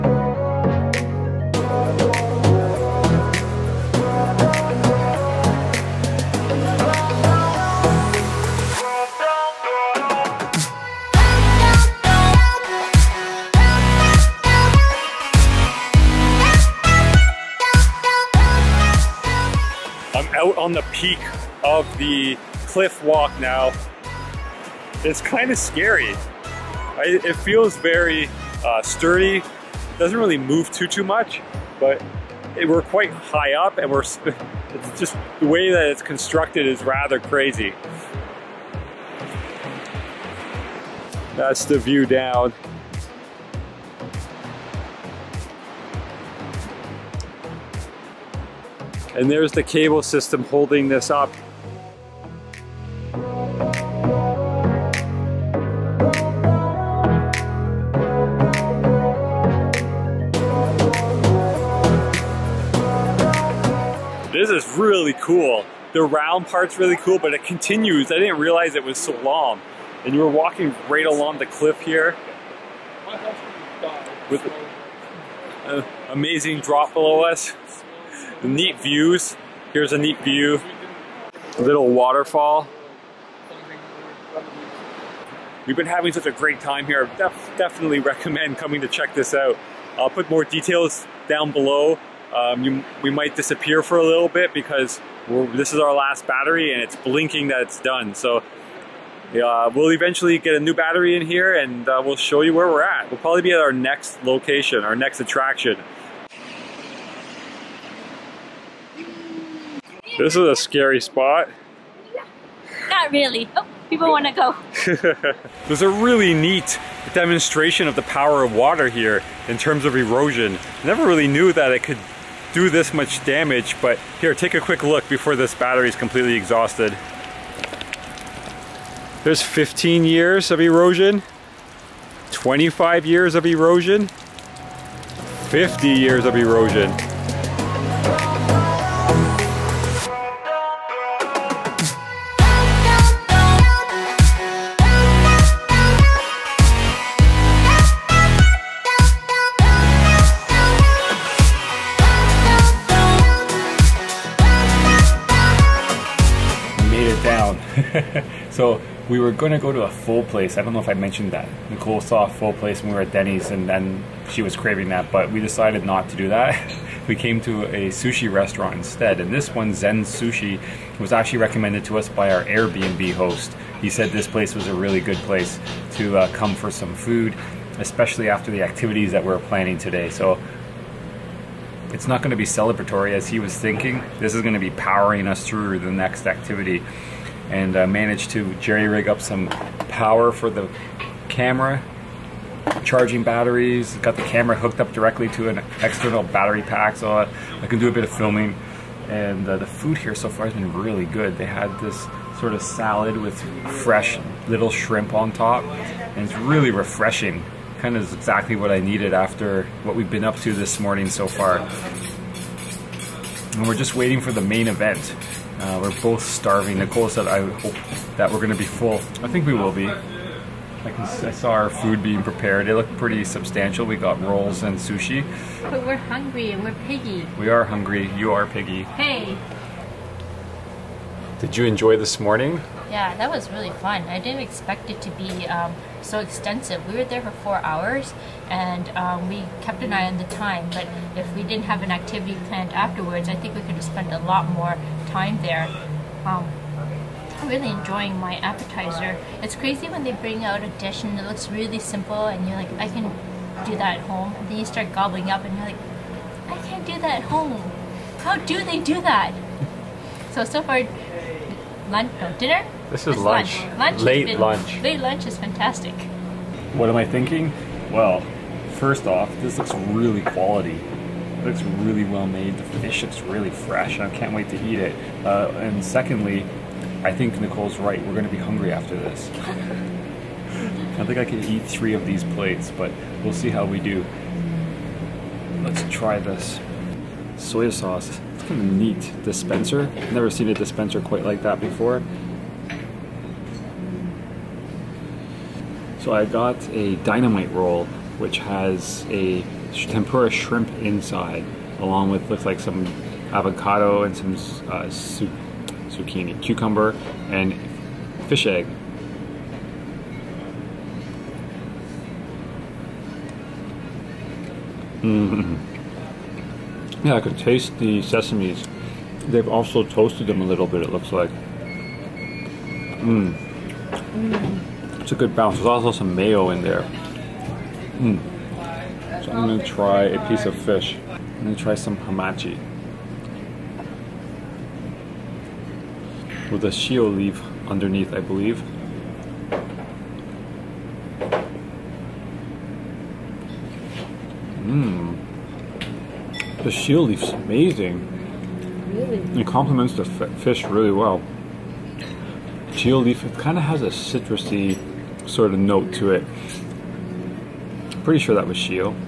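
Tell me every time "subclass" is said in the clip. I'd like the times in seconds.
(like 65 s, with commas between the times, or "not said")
not said.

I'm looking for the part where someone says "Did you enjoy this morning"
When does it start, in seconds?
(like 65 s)
231 s.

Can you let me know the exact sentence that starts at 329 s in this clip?
So I'm gonna try a piece of fish.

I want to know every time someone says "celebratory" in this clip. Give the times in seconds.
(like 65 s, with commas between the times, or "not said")
182 s.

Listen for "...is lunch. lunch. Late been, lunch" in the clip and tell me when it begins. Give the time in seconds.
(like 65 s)
263 s.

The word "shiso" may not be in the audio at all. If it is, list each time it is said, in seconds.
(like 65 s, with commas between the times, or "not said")
336 s, 346 s, 352 s, 358 s.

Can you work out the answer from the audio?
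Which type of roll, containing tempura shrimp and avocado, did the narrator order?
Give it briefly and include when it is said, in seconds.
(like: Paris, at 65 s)
dynamite roll, at 297 s.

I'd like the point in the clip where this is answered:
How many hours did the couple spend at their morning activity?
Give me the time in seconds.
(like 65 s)
237 s.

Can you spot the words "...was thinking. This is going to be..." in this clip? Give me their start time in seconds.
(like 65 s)
183 s.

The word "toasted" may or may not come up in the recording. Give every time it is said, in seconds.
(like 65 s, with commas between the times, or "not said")
319 s.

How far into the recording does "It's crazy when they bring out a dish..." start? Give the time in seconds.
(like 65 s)
249 s.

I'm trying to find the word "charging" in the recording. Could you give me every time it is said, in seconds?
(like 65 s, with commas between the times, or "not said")
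192 s.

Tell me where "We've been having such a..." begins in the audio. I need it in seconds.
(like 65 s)
85 s.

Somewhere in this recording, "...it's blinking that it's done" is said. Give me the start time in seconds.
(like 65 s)
96 s.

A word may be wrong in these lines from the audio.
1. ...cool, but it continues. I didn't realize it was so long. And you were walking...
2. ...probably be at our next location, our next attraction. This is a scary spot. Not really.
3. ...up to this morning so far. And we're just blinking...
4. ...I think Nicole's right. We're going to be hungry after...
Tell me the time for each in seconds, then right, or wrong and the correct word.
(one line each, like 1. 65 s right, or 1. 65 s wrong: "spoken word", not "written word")
1. 66 s right
2. 103 s right
3. 210 s wrong: "waiting", not "blinking"
4. 277 s right.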